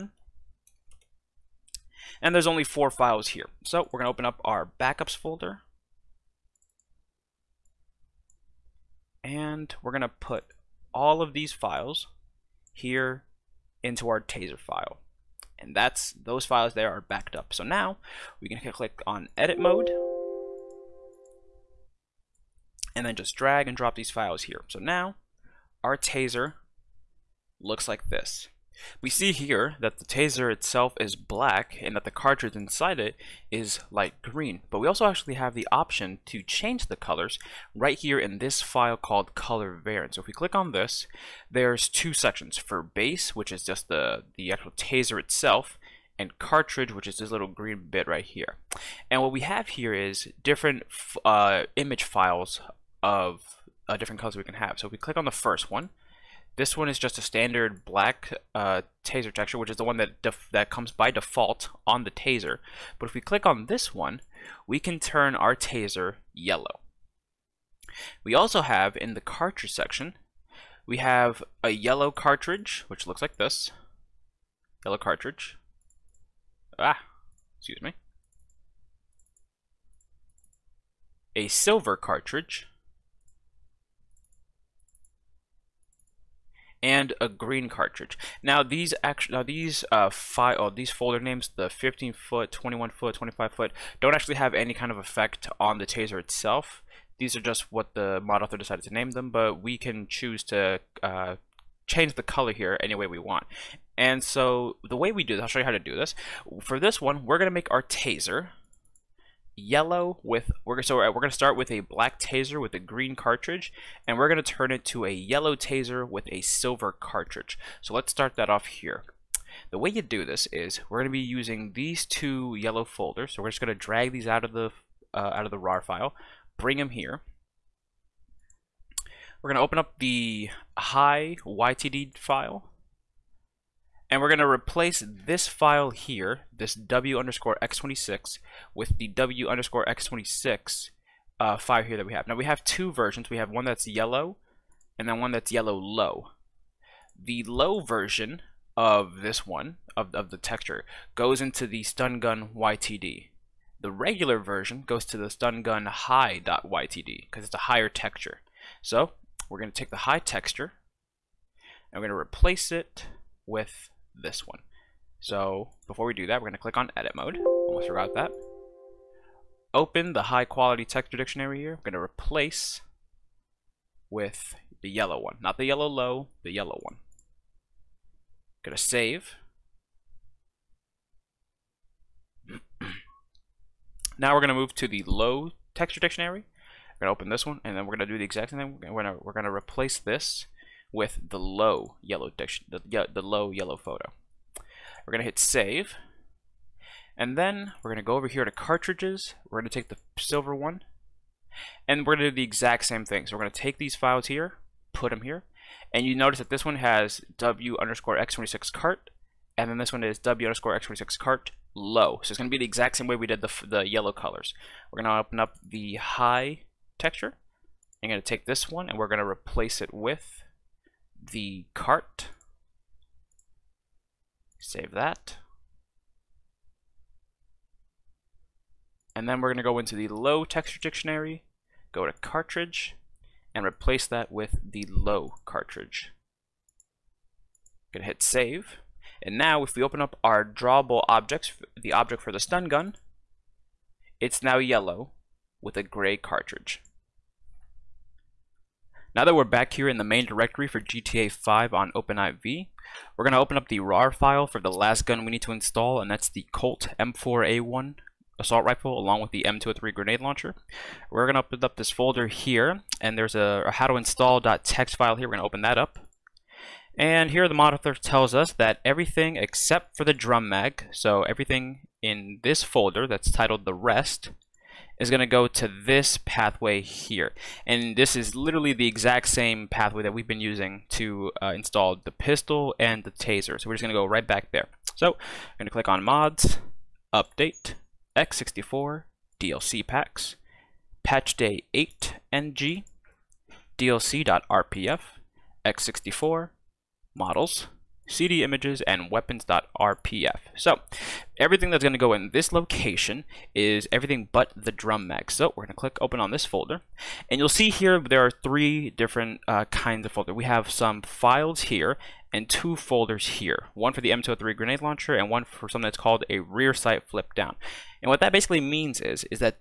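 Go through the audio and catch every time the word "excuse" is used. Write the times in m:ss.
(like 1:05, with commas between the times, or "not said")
1:17.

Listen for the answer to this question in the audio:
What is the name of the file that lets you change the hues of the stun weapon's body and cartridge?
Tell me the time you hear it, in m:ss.
0:39.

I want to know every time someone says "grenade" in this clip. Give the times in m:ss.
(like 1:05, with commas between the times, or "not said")
4:19, 5:14.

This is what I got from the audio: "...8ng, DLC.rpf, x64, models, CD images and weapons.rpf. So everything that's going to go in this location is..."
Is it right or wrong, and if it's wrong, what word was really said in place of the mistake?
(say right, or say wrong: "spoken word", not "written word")
right.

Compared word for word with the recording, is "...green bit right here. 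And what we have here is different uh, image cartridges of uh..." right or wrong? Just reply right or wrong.
wrong.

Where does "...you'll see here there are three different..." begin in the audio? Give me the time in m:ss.
5:07.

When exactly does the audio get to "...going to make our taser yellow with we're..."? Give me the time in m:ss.
1:47.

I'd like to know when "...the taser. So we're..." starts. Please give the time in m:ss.
4:43.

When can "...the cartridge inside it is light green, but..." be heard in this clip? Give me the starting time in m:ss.
0:32.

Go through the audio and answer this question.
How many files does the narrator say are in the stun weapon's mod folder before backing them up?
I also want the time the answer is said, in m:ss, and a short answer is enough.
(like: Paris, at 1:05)
4, at 0:02.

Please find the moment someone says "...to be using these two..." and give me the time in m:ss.
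2:01.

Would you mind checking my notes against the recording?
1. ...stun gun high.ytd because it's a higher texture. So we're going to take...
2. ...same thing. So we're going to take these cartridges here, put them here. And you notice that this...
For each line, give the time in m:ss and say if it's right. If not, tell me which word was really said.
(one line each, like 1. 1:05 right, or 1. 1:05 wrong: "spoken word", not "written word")
1. 2:35 right
2. 3:22 wrong: "files", not "cartridges".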